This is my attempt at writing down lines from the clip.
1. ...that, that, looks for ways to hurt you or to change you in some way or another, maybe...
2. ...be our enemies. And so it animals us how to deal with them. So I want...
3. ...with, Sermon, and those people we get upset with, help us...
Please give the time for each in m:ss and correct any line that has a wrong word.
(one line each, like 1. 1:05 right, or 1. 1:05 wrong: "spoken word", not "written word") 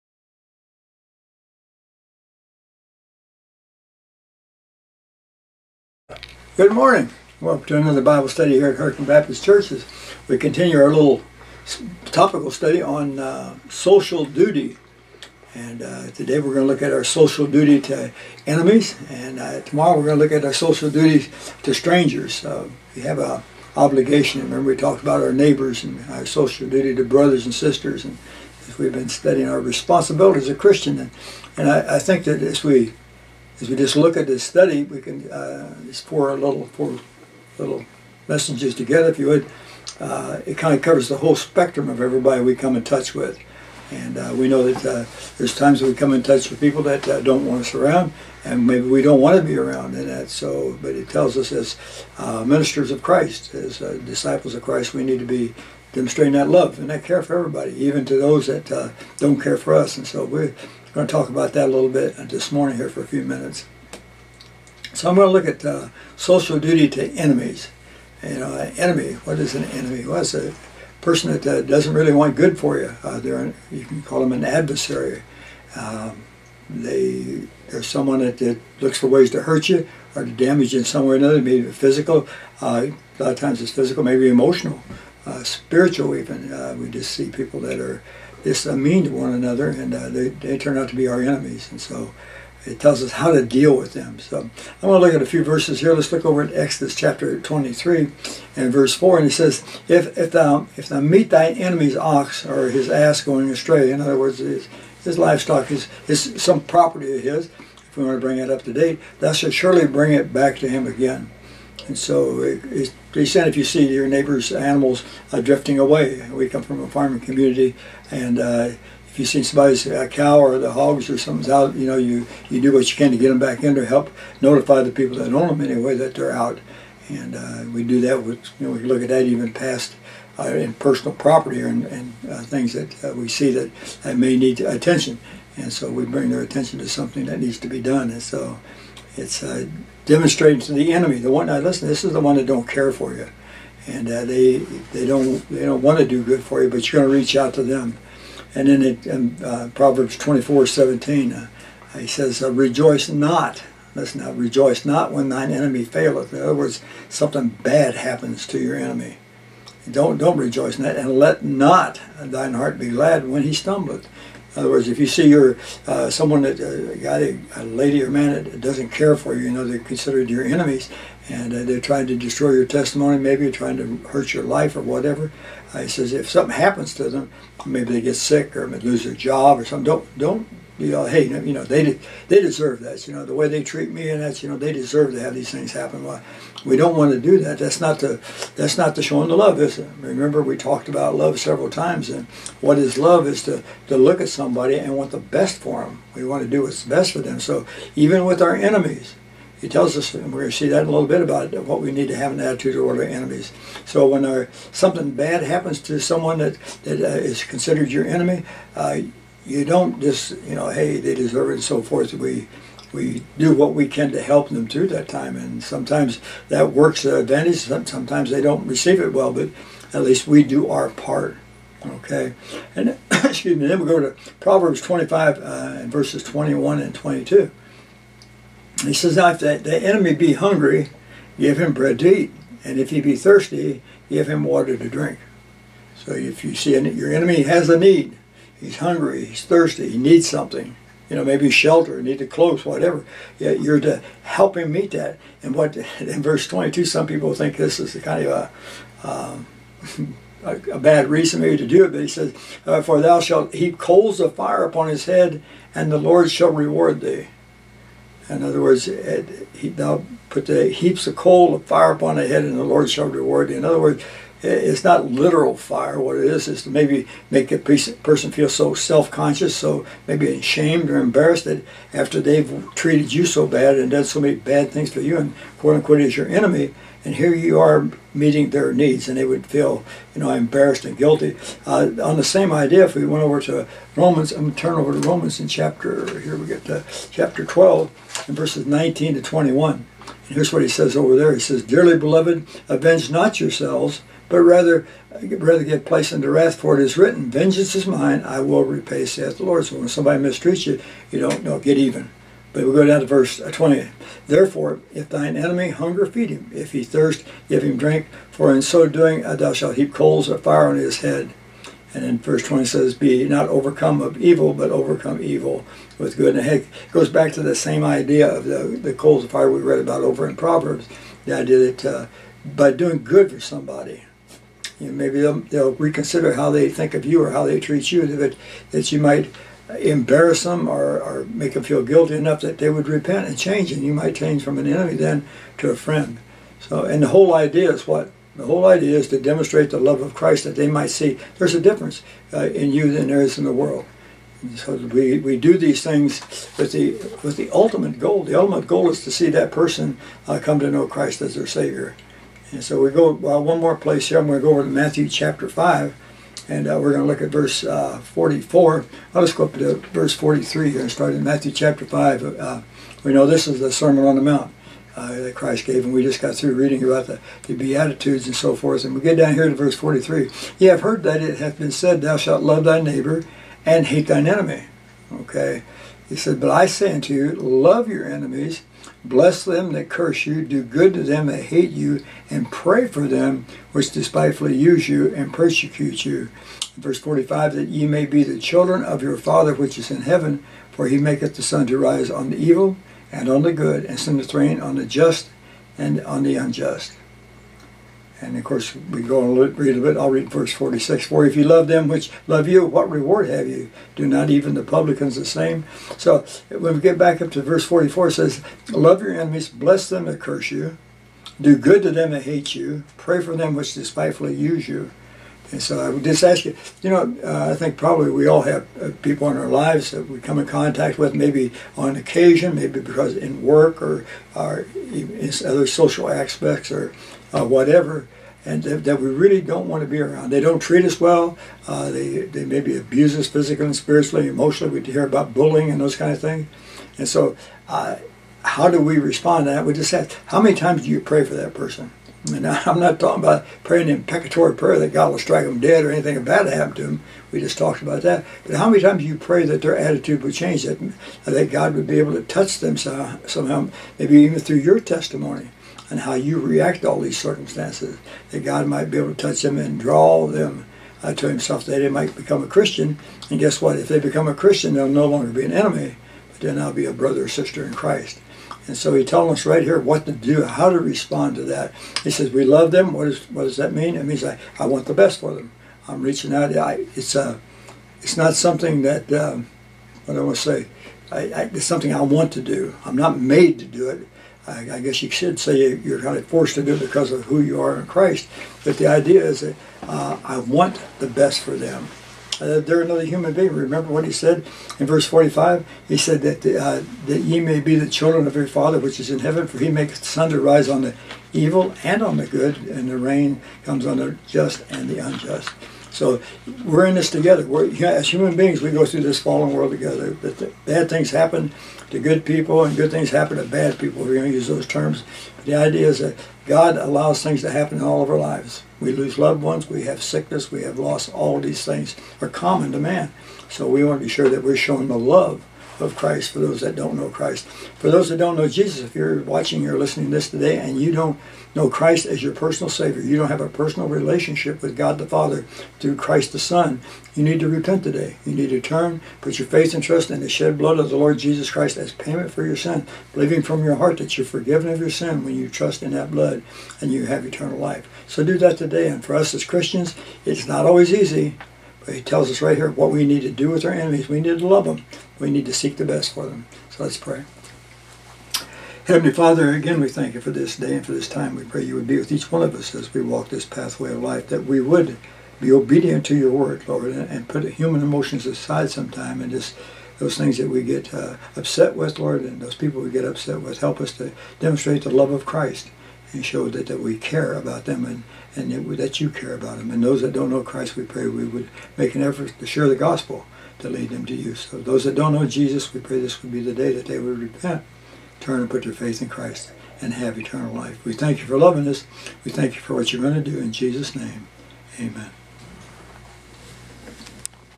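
1. 1:18 wrong: "damage", not "change"
2. 1:30 wrong: "tells", not "animals"
3. 9:31 wrong: "Lord", not "Sermon".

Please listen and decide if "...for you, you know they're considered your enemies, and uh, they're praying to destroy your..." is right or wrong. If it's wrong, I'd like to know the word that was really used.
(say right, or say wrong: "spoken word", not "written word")
wrong: "trying", not "praying".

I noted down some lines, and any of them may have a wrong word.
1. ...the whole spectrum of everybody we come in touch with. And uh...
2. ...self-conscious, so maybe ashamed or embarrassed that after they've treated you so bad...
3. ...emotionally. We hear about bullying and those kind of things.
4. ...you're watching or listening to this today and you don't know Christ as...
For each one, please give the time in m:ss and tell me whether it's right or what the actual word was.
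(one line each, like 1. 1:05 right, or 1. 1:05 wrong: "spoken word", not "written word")
1. 0:41 right
2. 4:28 right
3. 7:14 right
4. 8:48 right.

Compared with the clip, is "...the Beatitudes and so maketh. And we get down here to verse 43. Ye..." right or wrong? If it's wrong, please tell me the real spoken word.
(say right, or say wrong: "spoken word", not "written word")
wrong: "forth", not "maketh".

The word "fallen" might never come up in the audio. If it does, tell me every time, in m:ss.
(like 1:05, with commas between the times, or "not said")
8:29.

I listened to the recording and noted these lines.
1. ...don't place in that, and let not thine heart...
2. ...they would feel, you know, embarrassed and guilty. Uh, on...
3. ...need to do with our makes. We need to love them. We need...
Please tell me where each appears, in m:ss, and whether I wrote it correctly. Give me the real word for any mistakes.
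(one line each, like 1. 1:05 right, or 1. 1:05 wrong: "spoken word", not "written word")
1. 2:40 wrong: "rejoice", not "place"
2. 4:39 right
3. 9:13 wrong: "enemies", not "makes".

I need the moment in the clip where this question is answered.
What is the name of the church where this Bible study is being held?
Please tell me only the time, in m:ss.
0:08.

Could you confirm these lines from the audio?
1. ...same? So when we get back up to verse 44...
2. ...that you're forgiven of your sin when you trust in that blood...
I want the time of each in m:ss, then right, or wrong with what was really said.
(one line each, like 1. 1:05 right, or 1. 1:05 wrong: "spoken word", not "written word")
1. 6:45 right
2. 9:03 right.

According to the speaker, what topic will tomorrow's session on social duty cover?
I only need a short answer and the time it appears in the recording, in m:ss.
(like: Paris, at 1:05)
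Strangers, at 0:21.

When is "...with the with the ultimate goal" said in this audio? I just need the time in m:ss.
5:46.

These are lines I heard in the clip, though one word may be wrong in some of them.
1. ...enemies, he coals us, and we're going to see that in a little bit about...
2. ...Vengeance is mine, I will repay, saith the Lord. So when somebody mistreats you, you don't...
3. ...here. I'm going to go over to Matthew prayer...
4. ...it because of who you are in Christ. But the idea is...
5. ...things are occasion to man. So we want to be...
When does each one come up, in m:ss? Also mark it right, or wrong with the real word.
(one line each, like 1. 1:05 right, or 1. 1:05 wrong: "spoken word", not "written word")
1. 3:18 wrong: "tells", not "coals"
2. 4:57 right
3. 5:54 wrong: "chapter", not "prayer"
4. 8:06 right
5. 8:41 wrong: "common", not "occasion".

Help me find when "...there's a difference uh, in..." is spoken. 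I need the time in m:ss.
5:41.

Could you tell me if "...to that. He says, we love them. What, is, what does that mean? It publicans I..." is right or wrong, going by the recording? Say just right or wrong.
wrong.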